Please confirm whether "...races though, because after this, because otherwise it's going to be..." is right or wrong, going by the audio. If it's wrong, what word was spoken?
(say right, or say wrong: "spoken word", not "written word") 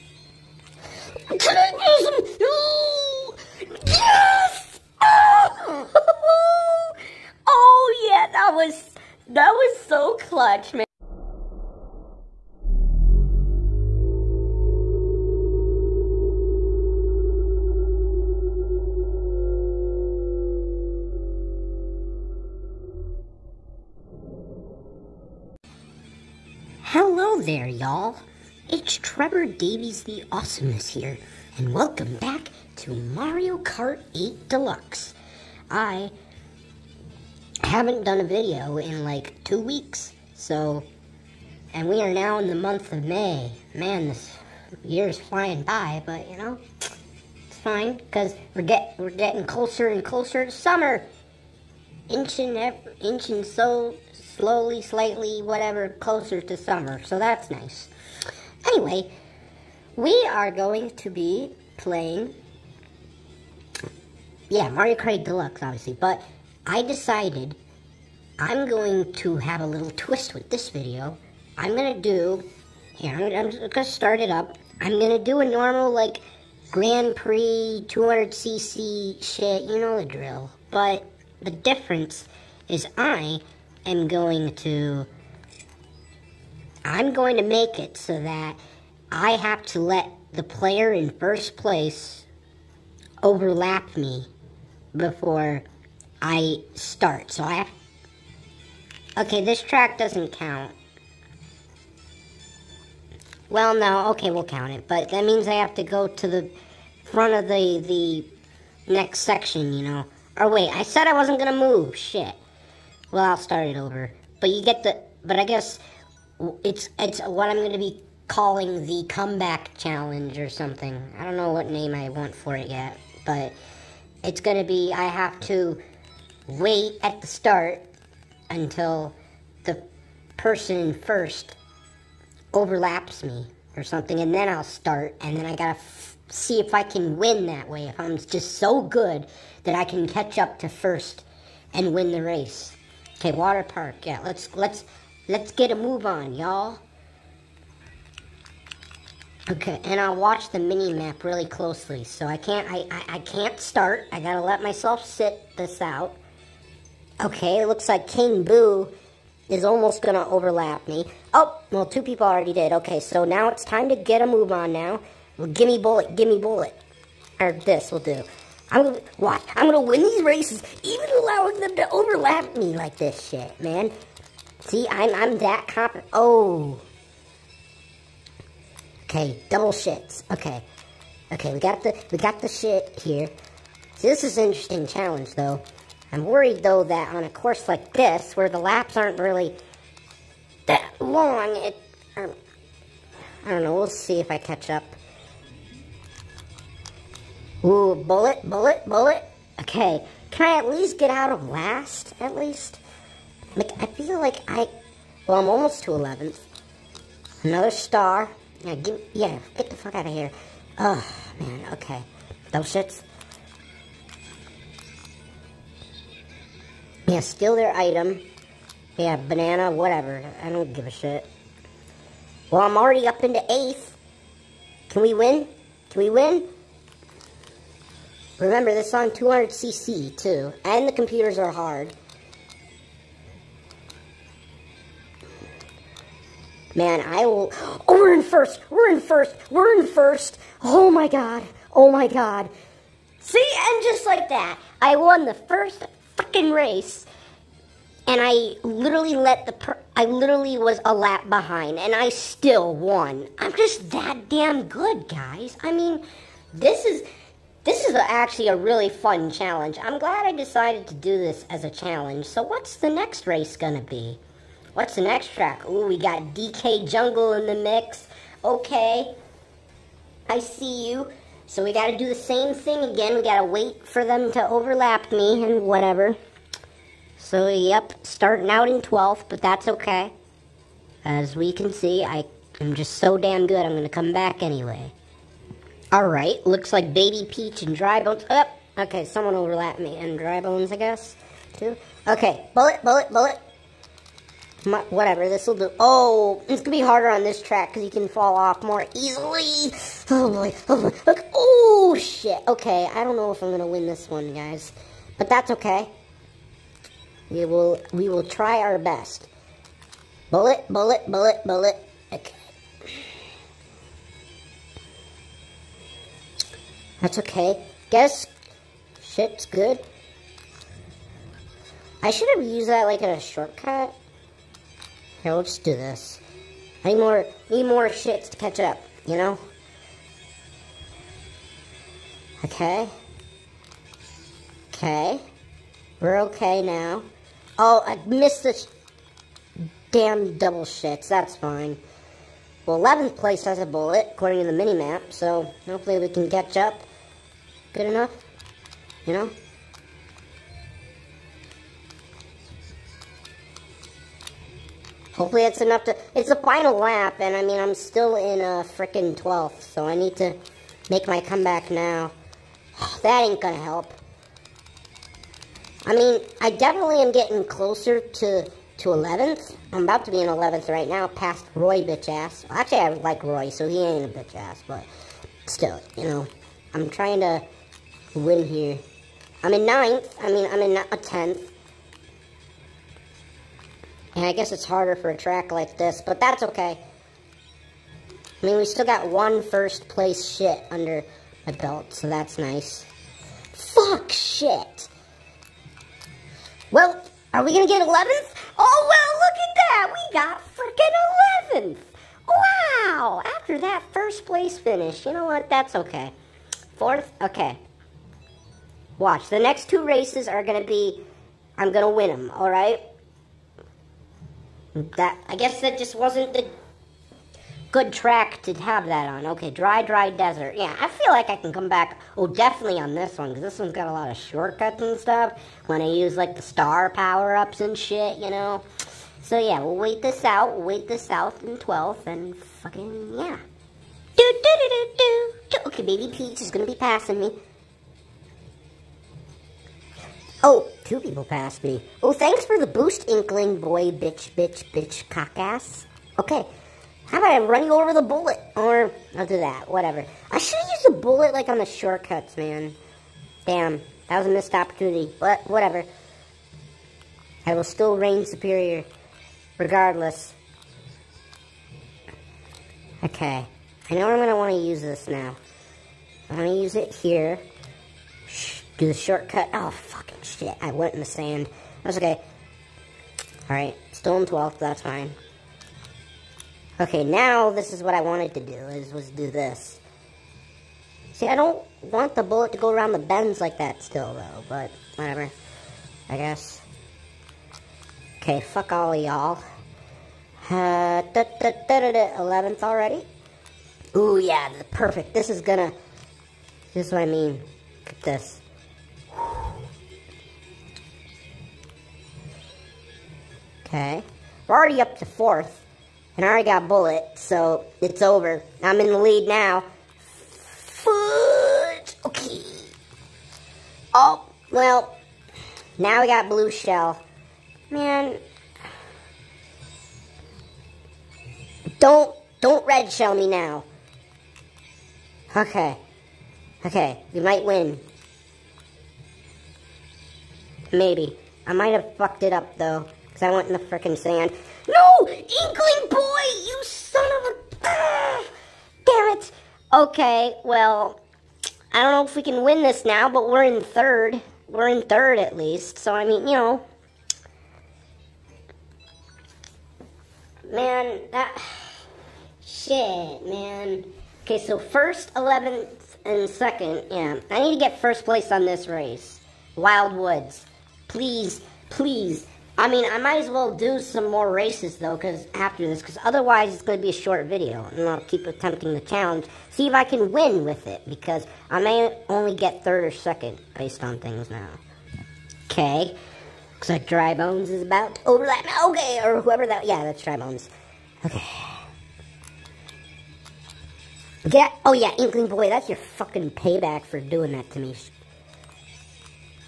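right.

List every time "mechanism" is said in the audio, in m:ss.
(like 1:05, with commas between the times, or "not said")
not said.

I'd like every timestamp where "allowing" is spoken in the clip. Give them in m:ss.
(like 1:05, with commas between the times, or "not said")
2:51.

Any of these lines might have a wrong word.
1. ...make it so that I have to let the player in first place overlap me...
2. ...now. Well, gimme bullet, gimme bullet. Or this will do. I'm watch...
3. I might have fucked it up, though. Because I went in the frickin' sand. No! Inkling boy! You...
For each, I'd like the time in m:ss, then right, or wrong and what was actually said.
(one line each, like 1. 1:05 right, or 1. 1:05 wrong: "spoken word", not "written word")
1. 1:27 right
2. 2:44 right
3. 8:51 right.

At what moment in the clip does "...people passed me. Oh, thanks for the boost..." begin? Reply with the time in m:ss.
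7:20.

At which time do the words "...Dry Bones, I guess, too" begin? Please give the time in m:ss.
4:50.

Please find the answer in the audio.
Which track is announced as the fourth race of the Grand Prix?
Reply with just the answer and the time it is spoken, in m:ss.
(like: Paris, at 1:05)
Wild Woods, at 9:19.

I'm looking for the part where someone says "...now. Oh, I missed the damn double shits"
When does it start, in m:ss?
5:36.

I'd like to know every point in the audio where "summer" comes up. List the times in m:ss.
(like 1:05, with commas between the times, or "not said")
0:50, 0:56.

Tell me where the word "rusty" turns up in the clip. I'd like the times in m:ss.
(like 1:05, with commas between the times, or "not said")
not said.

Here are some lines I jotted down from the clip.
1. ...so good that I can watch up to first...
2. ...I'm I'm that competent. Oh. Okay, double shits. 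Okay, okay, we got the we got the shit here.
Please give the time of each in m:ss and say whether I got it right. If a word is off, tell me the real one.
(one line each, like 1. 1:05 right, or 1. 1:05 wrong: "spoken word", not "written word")
1. 2:18 wrong: "catch", not "watch"
2. 2:54 right.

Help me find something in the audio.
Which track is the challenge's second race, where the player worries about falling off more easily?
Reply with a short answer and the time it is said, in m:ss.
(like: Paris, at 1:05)
DK Jungle, at 4:26.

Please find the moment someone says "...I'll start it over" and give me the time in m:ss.
1:53.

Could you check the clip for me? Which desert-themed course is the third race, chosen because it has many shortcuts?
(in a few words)
Dry Dry Desert.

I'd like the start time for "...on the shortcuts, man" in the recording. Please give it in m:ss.
7:31.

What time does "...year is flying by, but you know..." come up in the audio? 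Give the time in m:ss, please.
0:44.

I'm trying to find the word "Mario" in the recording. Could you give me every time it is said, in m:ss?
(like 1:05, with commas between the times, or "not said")
0:32, 1:04.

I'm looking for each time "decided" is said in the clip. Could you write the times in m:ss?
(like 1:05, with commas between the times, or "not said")
1:06, 4:20.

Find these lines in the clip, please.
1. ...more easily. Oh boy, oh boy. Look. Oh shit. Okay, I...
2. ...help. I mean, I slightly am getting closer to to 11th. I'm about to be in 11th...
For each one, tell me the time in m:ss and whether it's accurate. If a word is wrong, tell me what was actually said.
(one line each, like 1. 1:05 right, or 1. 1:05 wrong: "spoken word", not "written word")
1. 4:58 right
2. 6:03 wrong: "definitely", not "slightly".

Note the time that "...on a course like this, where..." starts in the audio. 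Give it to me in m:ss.
3:07.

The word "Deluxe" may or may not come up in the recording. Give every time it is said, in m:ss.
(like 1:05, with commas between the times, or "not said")
0:34, 1:05.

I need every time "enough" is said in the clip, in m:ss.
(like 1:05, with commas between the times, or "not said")
5:47, 5:55.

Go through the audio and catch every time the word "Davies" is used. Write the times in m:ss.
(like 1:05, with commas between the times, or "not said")
0:29.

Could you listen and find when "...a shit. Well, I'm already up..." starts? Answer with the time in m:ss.
3:40.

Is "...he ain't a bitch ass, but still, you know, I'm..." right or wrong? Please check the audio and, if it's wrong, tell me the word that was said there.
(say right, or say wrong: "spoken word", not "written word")
right.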